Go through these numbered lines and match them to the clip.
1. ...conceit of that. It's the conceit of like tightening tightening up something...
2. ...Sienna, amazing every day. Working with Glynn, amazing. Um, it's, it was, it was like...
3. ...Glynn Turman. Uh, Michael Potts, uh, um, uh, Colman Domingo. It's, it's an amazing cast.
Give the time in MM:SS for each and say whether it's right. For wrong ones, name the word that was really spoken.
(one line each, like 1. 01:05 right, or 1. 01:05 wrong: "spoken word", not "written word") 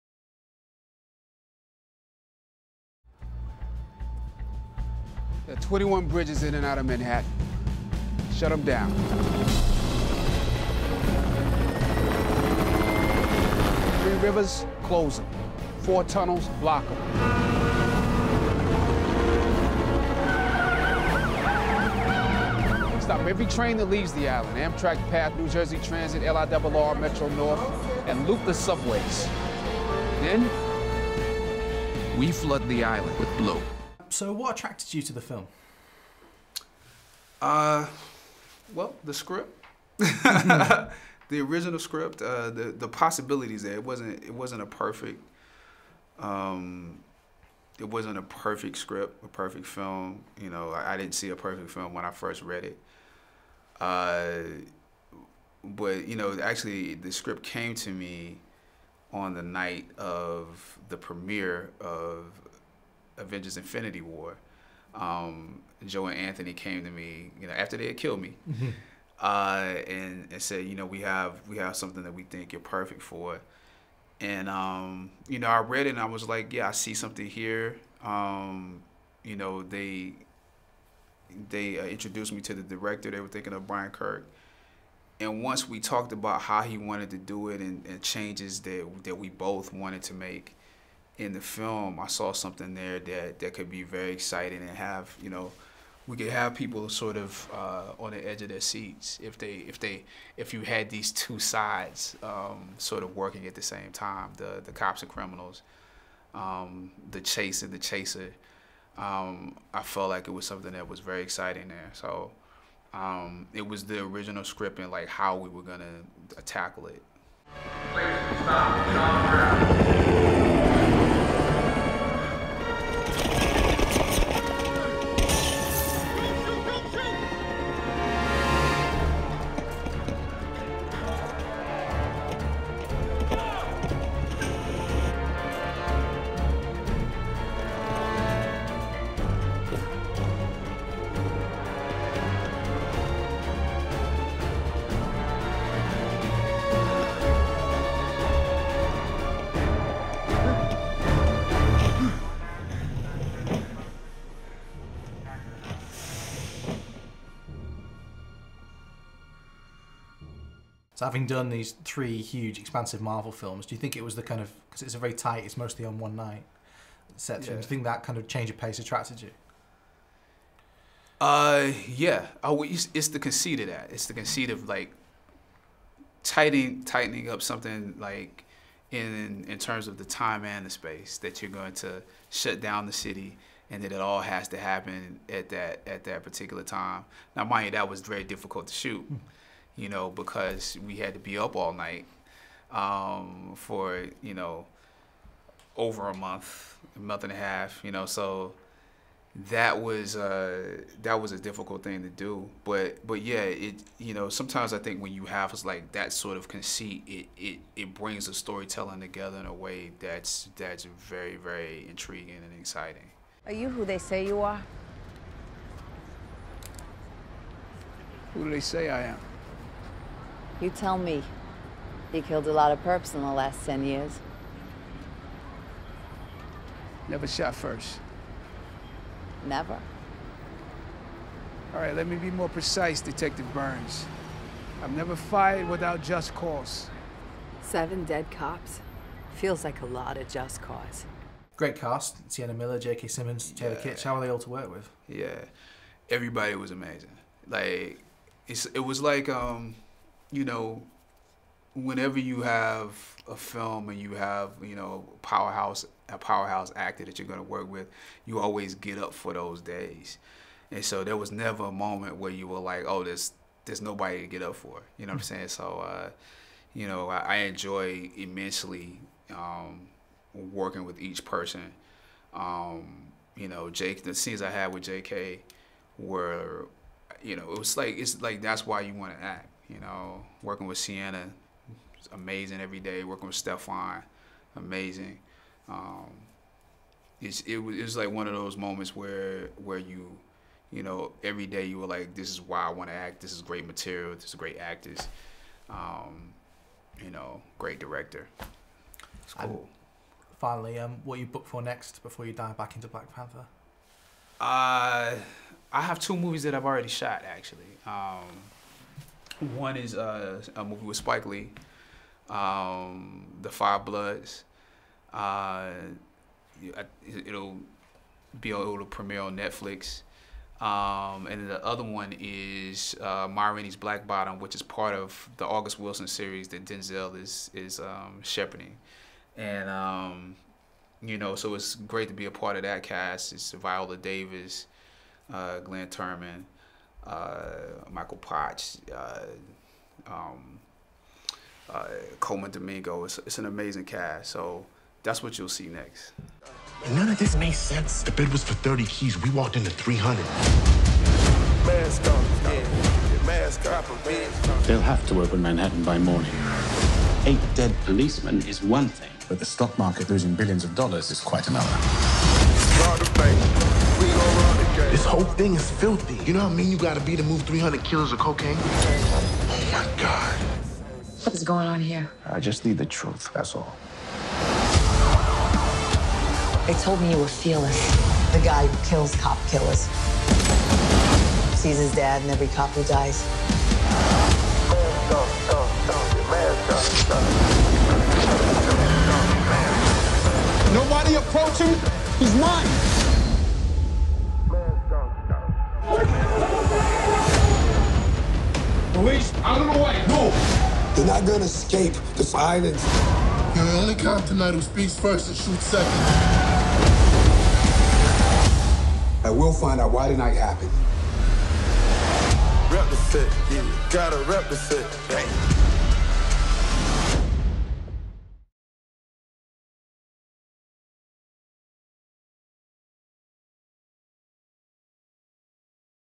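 1. 02:53 right
2. 04:40 wrong: "Stephan", not "Glynn"
3. 05:35 right.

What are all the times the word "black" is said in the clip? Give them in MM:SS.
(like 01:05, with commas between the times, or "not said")
05:02, 05:23.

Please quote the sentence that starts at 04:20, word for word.
And so there was never a moment where you were like, oh, there's there's nobody to get up for.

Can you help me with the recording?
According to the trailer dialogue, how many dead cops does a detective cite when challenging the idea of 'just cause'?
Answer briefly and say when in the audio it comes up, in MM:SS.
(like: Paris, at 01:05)
Seven, at 03:57.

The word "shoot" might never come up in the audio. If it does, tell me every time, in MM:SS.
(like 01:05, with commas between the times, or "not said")
03:08, 06:45.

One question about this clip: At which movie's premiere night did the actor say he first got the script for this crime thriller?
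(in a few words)
Avengers Infinity War.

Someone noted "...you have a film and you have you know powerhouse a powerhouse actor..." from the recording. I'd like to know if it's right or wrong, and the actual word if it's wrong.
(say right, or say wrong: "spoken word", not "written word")
right.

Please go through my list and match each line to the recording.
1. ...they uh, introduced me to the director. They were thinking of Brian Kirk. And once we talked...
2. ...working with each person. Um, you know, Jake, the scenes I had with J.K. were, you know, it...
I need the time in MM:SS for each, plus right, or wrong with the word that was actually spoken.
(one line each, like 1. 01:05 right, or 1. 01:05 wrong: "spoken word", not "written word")
1. 01:21 right
2. 04:30 right.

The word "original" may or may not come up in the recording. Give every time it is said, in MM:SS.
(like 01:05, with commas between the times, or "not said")
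00:41, 01:54.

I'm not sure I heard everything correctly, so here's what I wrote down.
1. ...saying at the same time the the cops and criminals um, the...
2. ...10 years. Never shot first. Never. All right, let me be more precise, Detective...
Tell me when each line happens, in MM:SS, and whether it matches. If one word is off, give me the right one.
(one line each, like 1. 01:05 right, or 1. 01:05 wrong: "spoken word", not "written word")
1. 01:43 wrong: "working", not "saying"
2. 03:43 right.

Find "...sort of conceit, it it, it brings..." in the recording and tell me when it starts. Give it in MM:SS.
03:26.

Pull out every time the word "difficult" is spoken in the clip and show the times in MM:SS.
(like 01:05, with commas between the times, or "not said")
03:08, 03:21.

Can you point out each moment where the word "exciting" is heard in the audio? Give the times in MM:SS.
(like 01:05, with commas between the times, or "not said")
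01:34, 01:51, 03:32.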